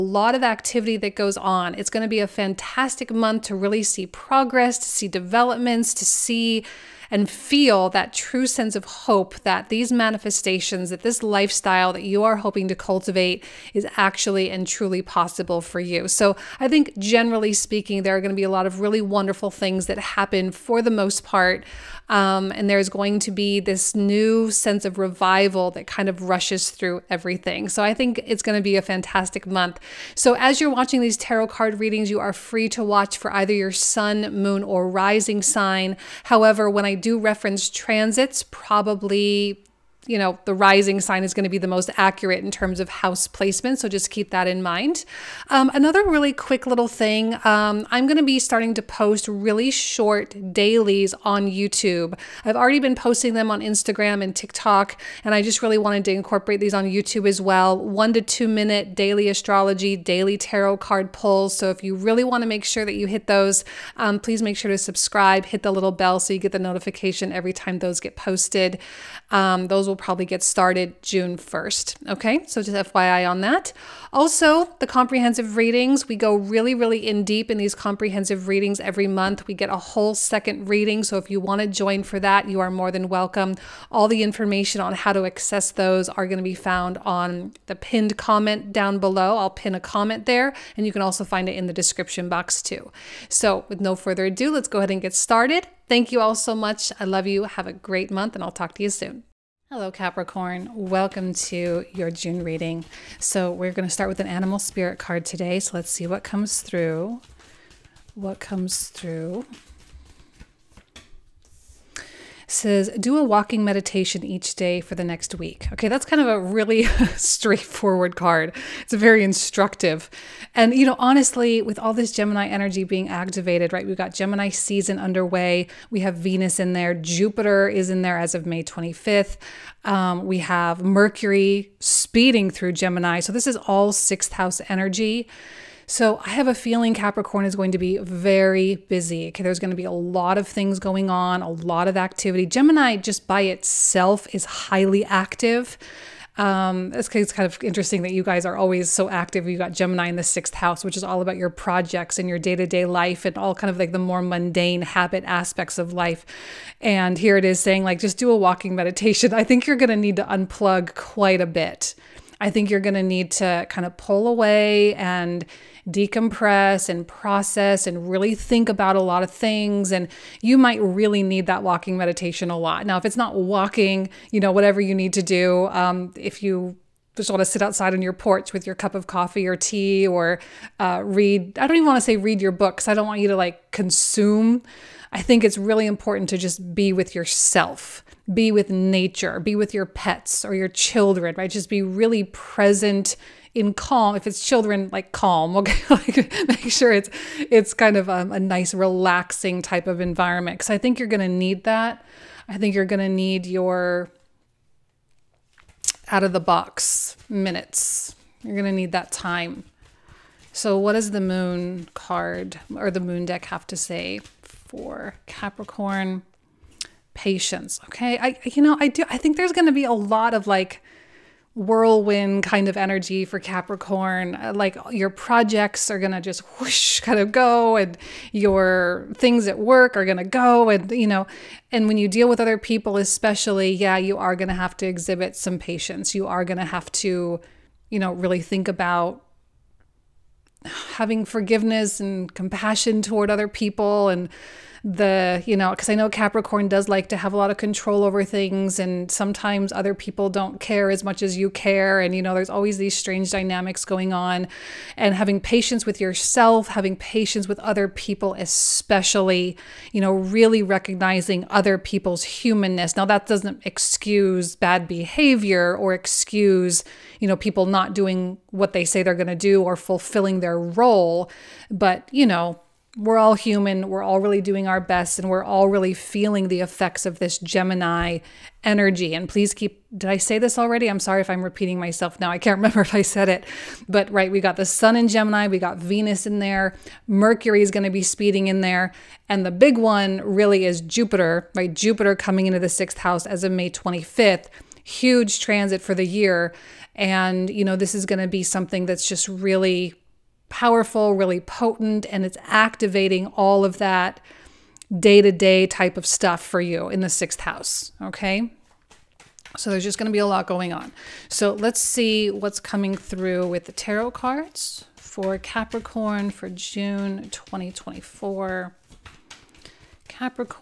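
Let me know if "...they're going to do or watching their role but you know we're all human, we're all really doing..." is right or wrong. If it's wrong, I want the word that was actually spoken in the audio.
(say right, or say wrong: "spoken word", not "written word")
wrong: "fulfilling", not "watching".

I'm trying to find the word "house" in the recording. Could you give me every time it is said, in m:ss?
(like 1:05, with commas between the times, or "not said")
0:42, 2:14, 2:30, 4:52, 5:07.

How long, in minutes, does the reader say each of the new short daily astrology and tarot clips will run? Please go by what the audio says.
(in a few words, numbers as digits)
1 to 2 minutes.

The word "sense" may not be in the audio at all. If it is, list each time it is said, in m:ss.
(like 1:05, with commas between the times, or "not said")
0:08, 0:24.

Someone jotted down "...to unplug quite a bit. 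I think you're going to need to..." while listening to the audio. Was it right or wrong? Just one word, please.
right.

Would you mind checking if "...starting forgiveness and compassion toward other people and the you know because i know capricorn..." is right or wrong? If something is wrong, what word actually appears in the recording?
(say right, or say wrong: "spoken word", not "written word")
wrong: "having", not "starting".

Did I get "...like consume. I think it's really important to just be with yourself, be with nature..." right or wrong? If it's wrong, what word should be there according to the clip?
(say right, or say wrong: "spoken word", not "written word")
right.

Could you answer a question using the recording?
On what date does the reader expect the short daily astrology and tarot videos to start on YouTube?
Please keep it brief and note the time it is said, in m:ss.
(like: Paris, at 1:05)
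June 1st, at 1:11.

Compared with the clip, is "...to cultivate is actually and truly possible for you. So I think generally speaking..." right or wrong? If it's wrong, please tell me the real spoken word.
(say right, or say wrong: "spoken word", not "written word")
right.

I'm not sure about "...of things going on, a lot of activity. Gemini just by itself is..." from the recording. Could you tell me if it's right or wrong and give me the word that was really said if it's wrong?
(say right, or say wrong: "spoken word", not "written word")
right.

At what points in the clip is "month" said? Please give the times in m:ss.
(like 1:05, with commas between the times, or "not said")
0:03, 0:29, 1:19, 1:38.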